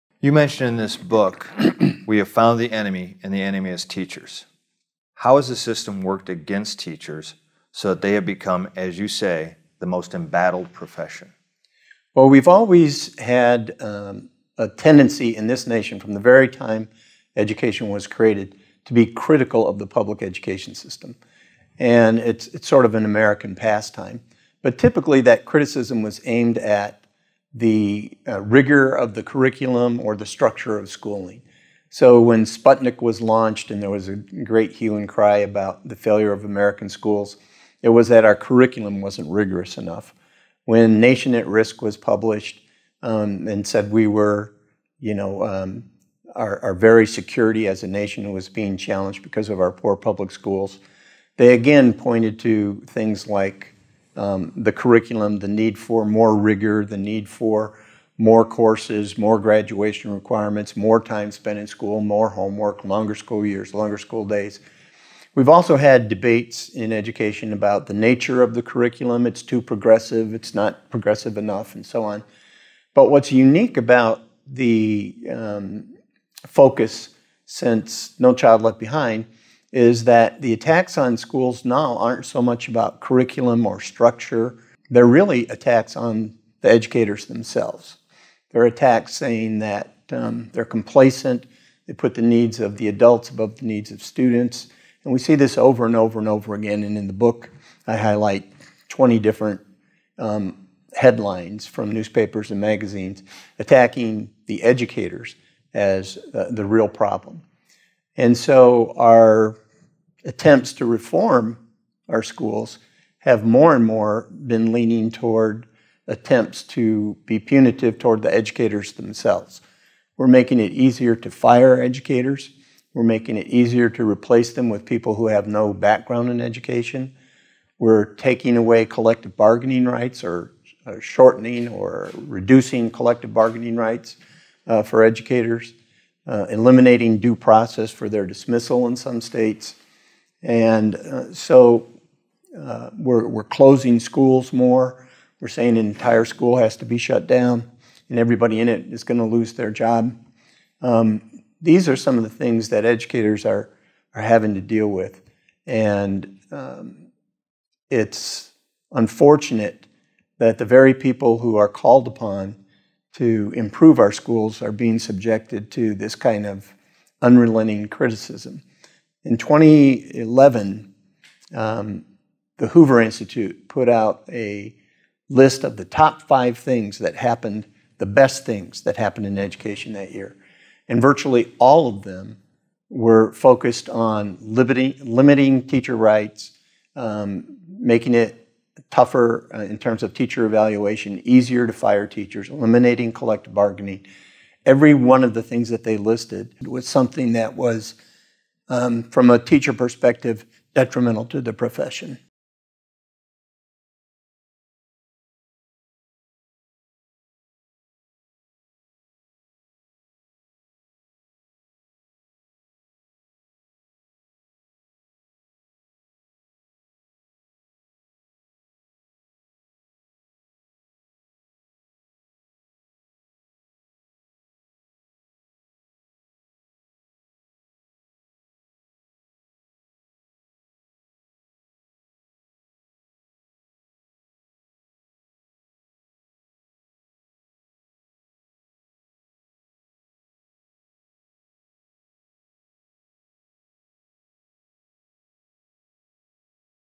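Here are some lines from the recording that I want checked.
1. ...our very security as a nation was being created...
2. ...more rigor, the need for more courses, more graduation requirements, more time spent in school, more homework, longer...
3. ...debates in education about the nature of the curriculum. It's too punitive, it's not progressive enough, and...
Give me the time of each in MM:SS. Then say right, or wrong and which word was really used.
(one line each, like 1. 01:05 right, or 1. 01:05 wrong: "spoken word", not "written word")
1. 00:46 wrong: "challenged", not "created"
2. 00:56 right
3. 01:06 wrong: "progressive", not "punitive".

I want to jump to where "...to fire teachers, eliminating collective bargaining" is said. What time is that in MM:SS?
03:11.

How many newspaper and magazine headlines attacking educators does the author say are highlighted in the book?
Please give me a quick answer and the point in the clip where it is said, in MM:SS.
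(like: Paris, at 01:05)
20, at 01:38.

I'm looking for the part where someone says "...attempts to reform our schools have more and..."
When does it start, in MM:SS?
01:50.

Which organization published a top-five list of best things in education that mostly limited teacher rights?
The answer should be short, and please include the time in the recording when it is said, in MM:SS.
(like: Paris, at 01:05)
Hoover Institute, at 02:52.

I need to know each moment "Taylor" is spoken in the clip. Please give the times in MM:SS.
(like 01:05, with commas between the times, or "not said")
not said.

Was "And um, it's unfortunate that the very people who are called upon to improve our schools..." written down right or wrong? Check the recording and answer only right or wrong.
right.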